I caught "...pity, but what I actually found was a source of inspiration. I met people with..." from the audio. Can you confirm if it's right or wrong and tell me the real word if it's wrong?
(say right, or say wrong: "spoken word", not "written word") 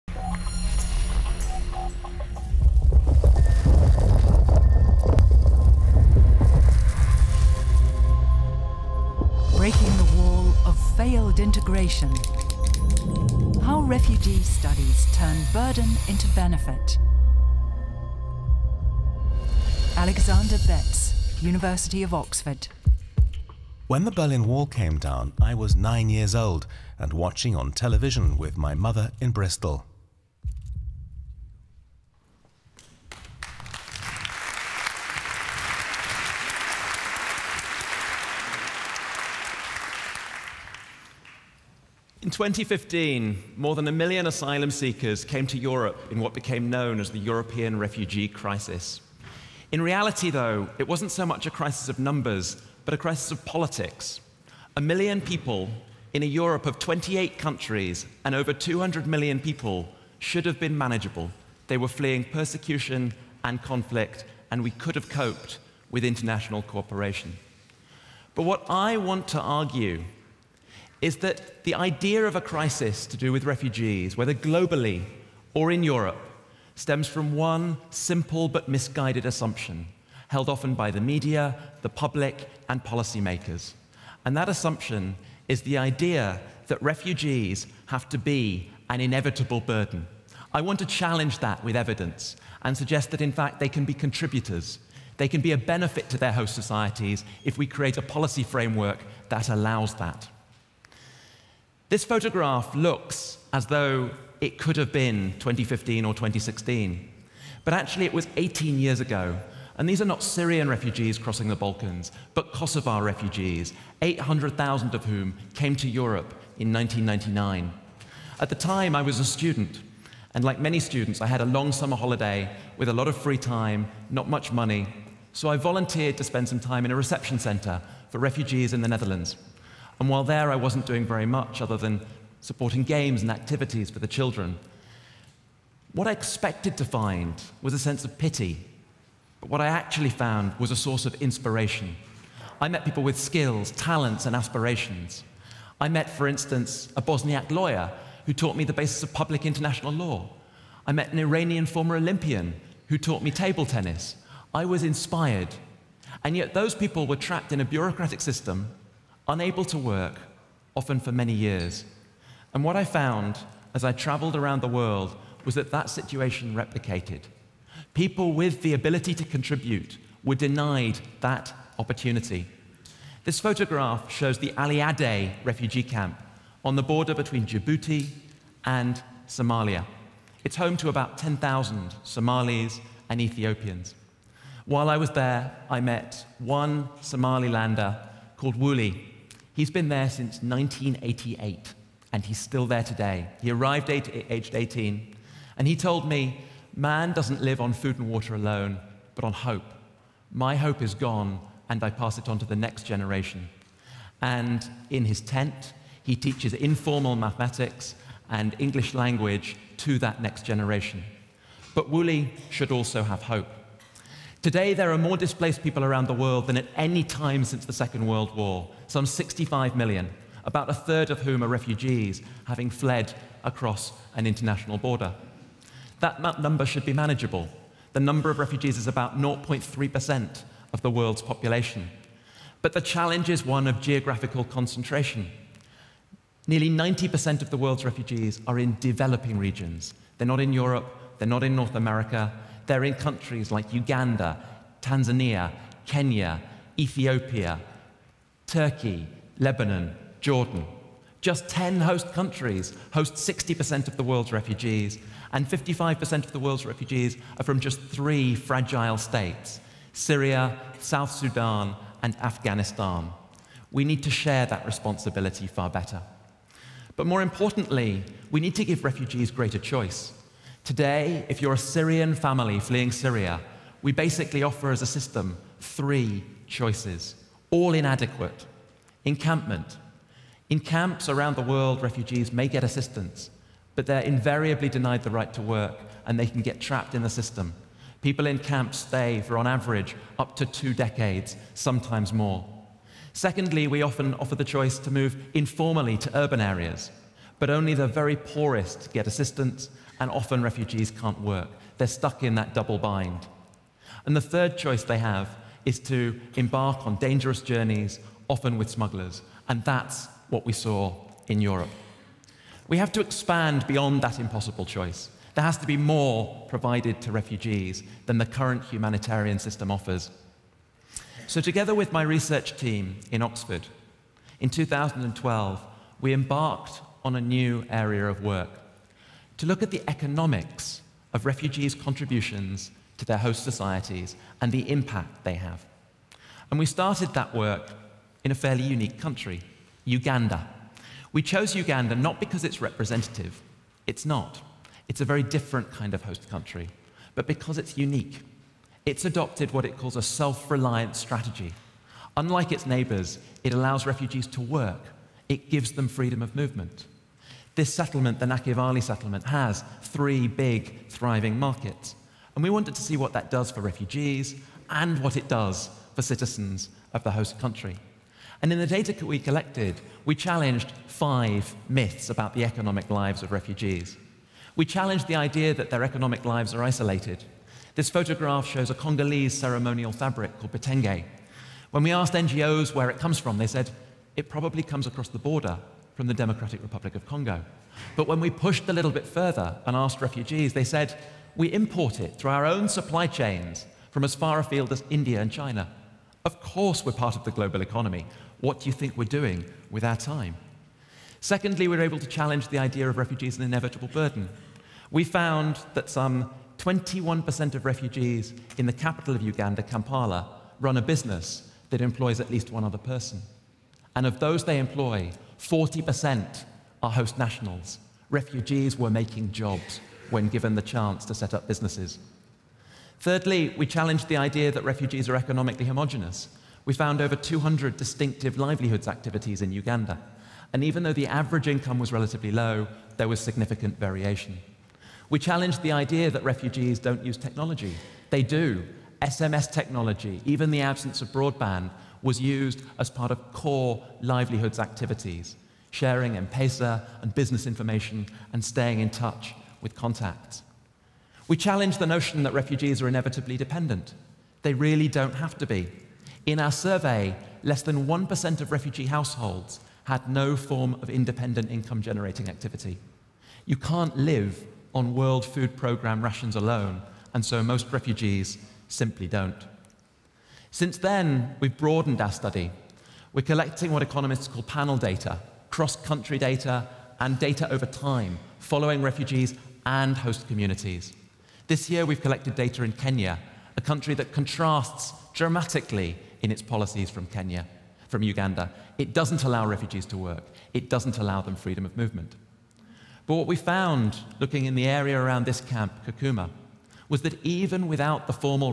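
right.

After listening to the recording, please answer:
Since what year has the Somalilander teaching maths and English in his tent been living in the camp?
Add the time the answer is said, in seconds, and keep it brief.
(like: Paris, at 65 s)
1988, at 190 s.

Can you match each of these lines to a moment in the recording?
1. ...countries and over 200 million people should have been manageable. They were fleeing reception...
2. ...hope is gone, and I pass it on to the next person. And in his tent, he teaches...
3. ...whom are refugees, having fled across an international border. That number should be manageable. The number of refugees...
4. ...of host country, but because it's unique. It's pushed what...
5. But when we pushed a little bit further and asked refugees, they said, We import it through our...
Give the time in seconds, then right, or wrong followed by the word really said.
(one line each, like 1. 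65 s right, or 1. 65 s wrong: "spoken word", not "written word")
1. 57 s wrong: "persecution", not "reception"
2. 200 s wrong: "generation", not "person"
3. 221 s right
4. 345 s wrong: "adopted", not "pushed"
5. 387 s right.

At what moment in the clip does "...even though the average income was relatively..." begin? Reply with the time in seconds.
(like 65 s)
430 s.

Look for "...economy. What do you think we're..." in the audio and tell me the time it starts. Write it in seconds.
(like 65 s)
397 s.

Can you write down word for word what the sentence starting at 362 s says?
And we wanted to see what that does for refugees and what it does for citizens of the host country.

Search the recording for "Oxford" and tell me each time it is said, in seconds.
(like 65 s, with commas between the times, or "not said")
22 s, 323 s.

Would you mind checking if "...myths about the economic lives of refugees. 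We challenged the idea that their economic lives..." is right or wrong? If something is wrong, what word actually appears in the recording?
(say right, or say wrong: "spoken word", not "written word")
right.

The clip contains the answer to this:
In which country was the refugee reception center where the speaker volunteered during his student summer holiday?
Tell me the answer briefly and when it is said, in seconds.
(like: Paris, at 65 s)
the Netherlands, at 128 s.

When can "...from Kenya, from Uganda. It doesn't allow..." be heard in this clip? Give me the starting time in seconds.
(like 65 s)
486 s.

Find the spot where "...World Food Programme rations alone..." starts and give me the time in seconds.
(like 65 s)
464 s.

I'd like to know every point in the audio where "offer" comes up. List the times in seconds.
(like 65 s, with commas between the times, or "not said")
274 s, 294 s, 319 s.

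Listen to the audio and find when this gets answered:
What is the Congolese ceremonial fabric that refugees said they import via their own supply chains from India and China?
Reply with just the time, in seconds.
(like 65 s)
380 s.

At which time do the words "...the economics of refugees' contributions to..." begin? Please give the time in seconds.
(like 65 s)
329 s.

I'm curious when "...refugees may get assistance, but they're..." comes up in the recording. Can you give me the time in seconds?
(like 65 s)
281 s.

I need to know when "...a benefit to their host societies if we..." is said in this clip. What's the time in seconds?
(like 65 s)
95 s.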